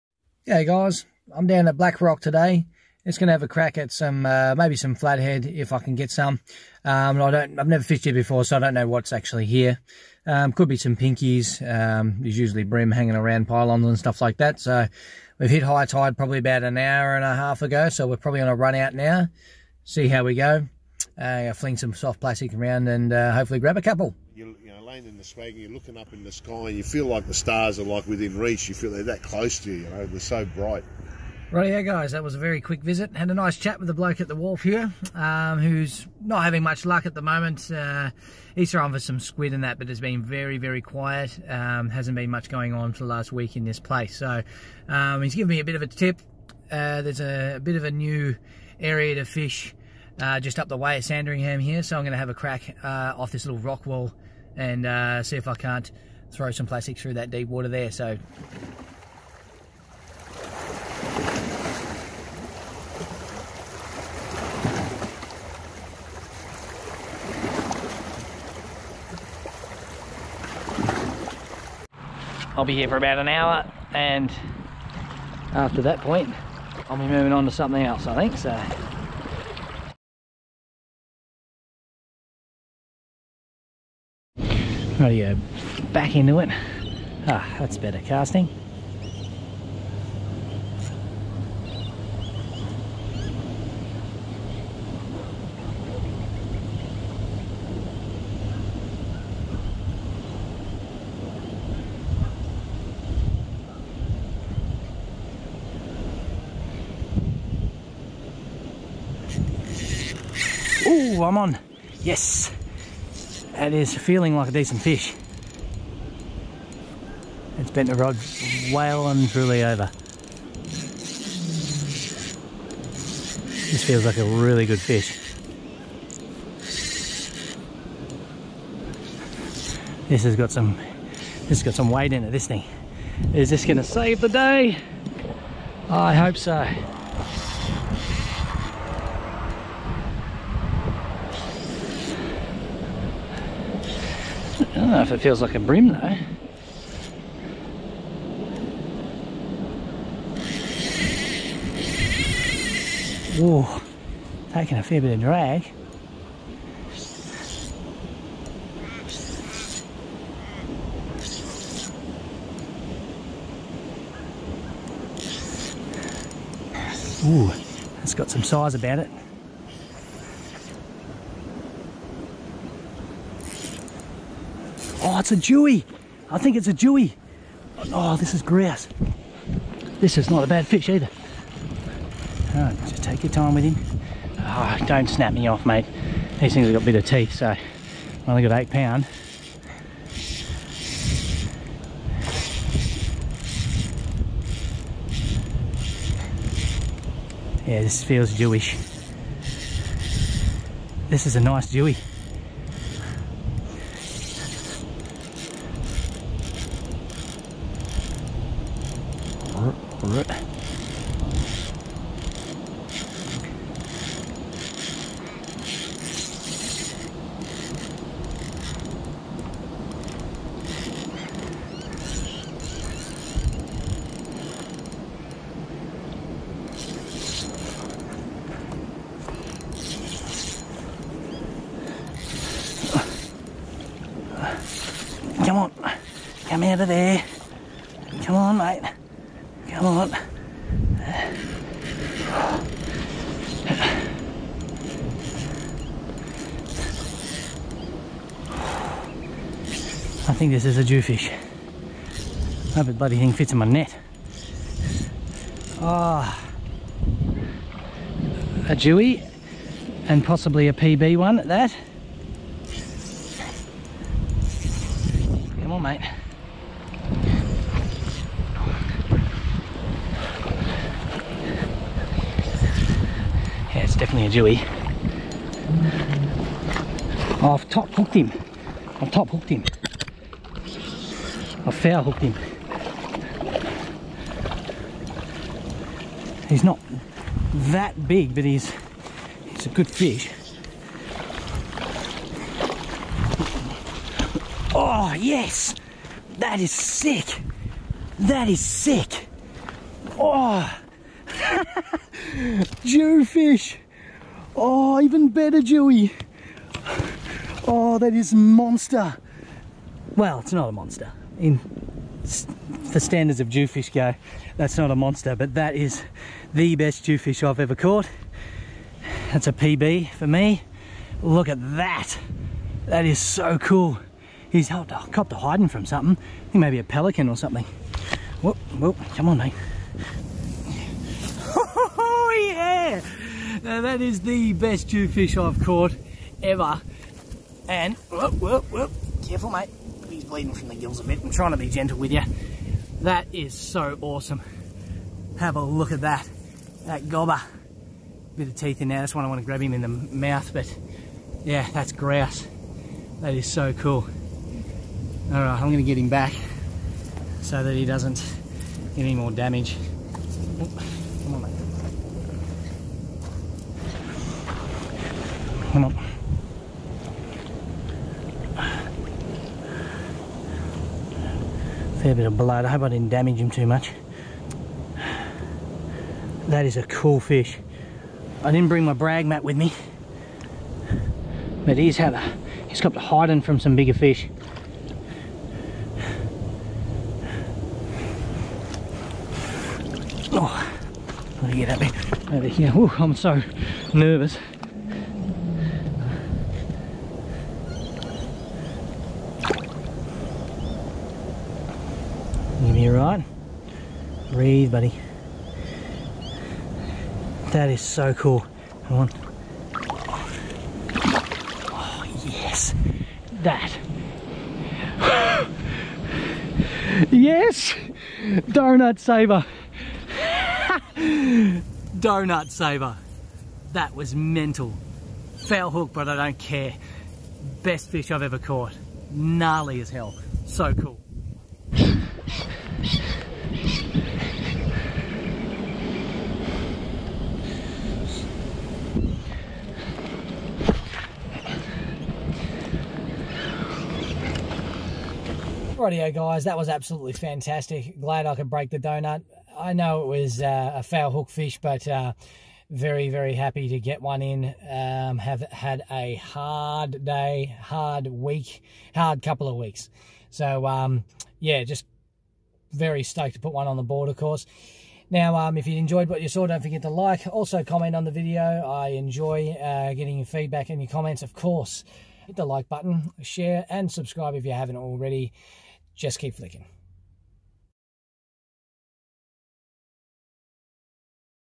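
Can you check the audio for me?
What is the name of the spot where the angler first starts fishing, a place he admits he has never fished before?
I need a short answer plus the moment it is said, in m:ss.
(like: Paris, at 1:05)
Black Rock, at 0:01.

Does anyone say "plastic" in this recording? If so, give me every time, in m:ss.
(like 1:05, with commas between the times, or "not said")
0:22, 0:56.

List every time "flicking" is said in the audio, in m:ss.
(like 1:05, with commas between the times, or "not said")
7:56.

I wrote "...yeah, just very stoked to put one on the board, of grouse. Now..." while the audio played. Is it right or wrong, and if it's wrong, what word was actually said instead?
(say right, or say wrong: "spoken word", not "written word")
wrong: "course", not "grouse".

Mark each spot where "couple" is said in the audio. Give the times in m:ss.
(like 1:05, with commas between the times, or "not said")
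0:23, 7:39.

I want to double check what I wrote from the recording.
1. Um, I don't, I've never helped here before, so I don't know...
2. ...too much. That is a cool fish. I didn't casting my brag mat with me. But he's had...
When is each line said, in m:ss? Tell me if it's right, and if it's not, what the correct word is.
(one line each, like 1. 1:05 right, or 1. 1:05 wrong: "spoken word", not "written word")
1. 0:06 wrong: "fished", not "helped"
2. 6:13 wrong: "bring", not "casting".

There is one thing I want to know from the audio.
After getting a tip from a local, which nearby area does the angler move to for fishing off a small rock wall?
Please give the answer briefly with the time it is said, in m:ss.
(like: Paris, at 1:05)
Sandringham, at 0:51.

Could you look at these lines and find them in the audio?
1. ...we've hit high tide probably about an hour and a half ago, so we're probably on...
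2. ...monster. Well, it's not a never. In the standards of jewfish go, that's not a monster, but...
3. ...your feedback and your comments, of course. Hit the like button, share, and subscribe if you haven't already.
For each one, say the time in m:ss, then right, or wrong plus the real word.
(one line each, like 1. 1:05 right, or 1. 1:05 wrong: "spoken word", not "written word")
1. 0:15 right
2. 5:08 wrong: "monster", not "never"
3. 7:50 right.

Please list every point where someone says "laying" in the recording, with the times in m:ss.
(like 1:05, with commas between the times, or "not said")
0:24.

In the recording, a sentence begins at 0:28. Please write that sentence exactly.
You feel they're that close to you, you know, they're so bright.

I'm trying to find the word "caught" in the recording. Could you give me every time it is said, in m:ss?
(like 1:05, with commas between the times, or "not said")
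5:17, 5:35, 7:08.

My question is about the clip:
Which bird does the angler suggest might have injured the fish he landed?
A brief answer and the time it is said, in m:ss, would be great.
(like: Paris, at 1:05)
Pelican, at 5:26.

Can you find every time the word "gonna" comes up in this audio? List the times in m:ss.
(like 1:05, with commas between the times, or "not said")
2:13, 5:55.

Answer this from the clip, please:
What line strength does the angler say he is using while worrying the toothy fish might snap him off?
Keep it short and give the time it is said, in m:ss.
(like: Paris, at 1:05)
8 pound, at 3:08.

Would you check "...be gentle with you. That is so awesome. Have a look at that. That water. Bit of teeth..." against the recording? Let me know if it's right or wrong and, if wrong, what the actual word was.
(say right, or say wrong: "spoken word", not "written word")
wrong: "gobber", not "water".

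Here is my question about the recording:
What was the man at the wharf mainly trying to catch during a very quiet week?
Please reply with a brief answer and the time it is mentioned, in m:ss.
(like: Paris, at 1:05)
Squid, at 0:39.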